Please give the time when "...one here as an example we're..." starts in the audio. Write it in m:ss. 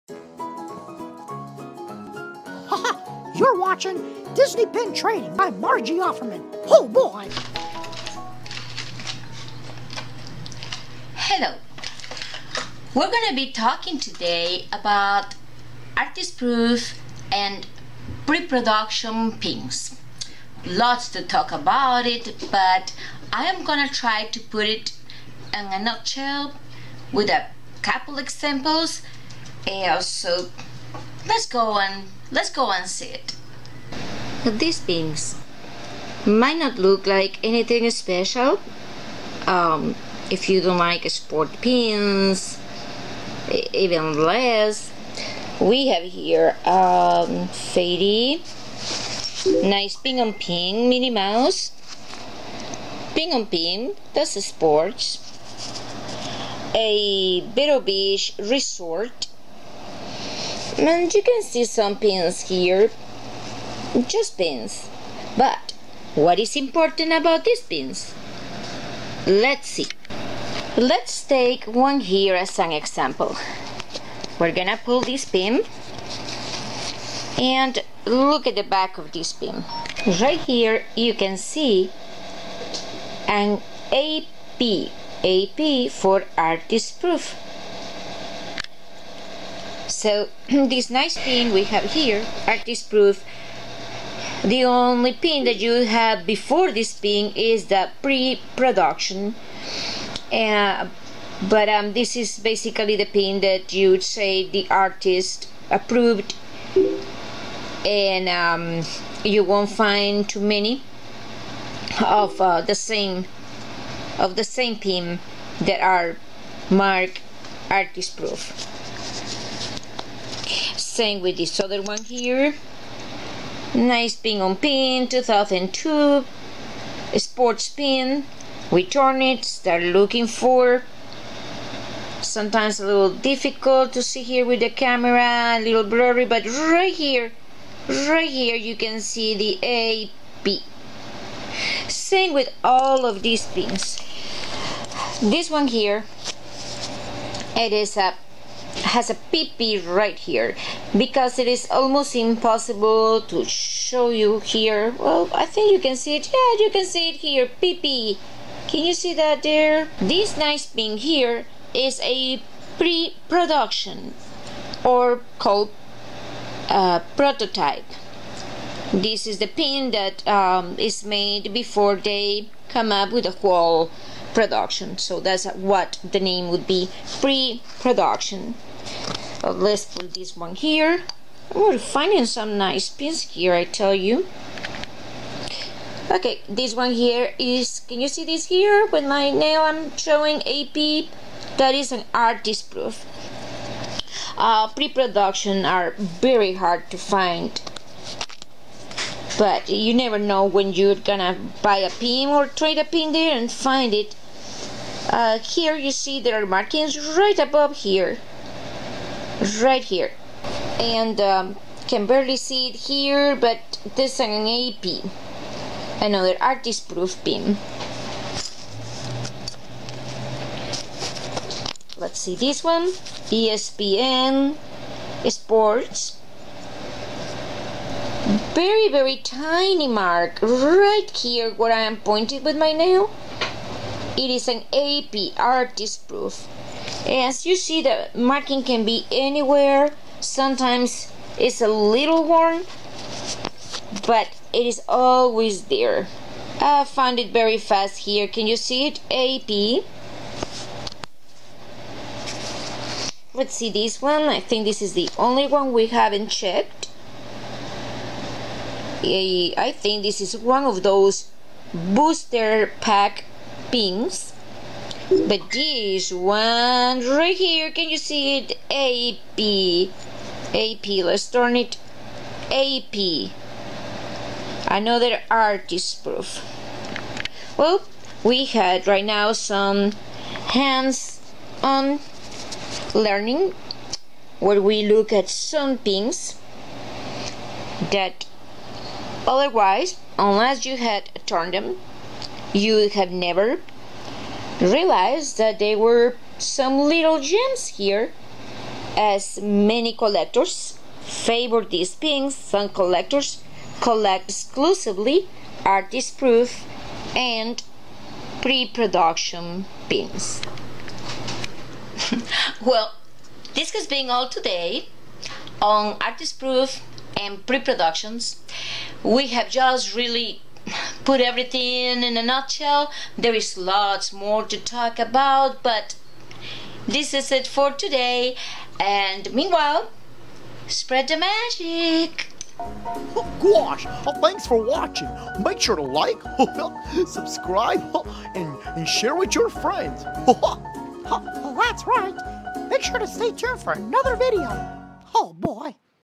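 1:11.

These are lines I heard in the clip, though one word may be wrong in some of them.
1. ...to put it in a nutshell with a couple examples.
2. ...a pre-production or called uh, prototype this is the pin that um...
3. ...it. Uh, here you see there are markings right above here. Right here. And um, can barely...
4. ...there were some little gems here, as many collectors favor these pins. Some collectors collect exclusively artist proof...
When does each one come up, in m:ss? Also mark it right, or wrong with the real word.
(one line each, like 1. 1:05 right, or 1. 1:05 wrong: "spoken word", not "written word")
1. 0:24 right
2. 2:42 right
3. 3:23 right
4. 4:55 right.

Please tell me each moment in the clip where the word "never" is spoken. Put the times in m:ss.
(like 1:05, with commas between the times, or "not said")
3:19, 4:53.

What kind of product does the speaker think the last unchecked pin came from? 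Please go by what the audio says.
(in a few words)
booster pack.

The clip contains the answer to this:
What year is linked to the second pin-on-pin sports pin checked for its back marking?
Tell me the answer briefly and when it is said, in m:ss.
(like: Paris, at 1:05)
2002, at 2:05.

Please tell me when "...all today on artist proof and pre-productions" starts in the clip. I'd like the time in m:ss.
5:14.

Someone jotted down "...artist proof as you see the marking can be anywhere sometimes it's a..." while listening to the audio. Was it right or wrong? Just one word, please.
right.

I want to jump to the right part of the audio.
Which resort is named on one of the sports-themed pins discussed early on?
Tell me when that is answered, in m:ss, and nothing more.
0:57.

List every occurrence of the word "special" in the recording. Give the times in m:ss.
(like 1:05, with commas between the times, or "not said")
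0:37.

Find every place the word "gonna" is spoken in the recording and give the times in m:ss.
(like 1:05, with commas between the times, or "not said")
1:14, 3:21.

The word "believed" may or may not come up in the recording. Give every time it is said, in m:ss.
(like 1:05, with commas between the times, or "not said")
not said.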